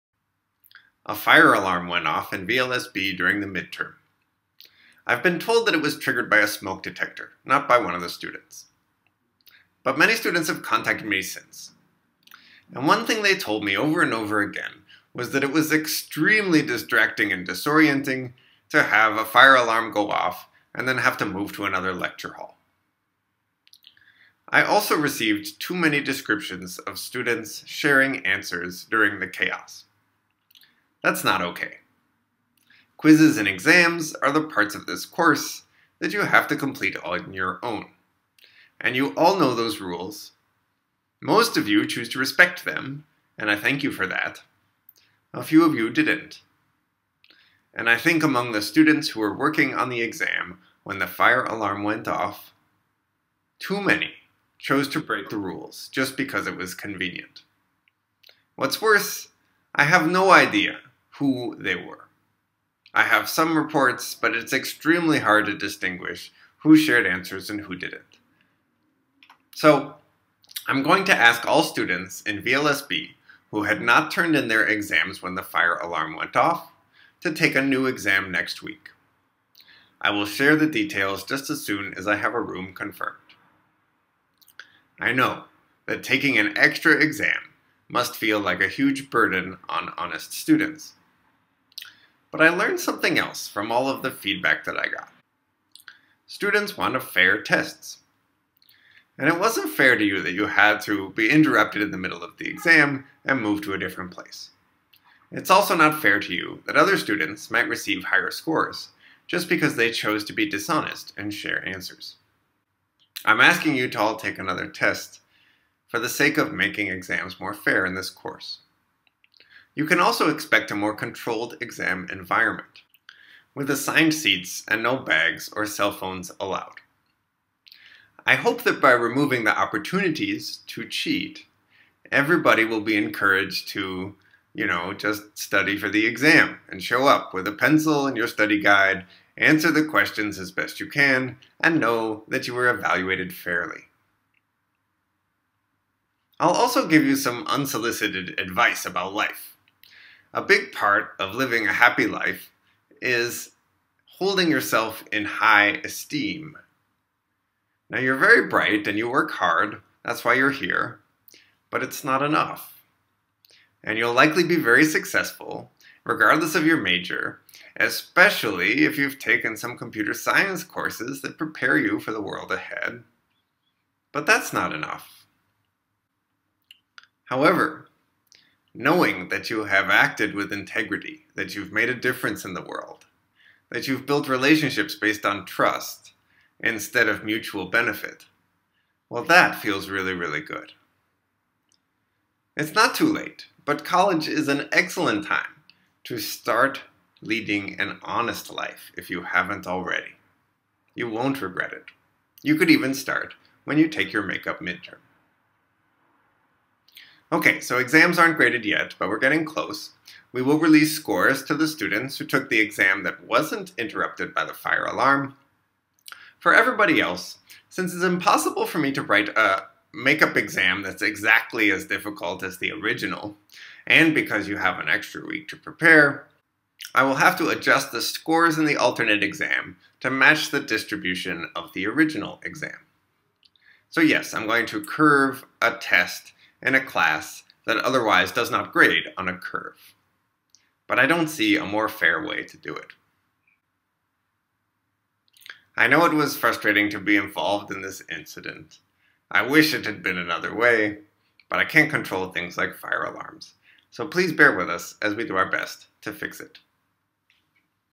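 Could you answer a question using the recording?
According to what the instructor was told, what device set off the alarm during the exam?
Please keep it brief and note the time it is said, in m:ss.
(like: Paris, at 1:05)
a smoke detector, at 0:06.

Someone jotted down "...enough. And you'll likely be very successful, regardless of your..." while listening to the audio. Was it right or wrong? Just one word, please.
right.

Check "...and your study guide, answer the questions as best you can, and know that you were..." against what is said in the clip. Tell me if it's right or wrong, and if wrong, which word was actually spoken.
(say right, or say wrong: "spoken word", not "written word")
right.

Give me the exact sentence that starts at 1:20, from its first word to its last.
I will share the details just as soon as I have a room confirmed.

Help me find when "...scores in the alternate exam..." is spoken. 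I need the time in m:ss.
3:48.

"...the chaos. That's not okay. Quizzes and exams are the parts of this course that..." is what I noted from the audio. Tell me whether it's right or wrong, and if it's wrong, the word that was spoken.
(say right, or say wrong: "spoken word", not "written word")
right.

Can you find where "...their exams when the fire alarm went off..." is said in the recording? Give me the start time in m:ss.
1:14.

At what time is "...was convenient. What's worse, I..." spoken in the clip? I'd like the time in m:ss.
0:56.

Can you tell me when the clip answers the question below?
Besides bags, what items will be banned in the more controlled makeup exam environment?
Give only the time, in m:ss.
2:05.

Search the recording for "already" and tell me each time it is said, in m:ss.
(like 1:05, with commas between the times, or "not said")
3:19.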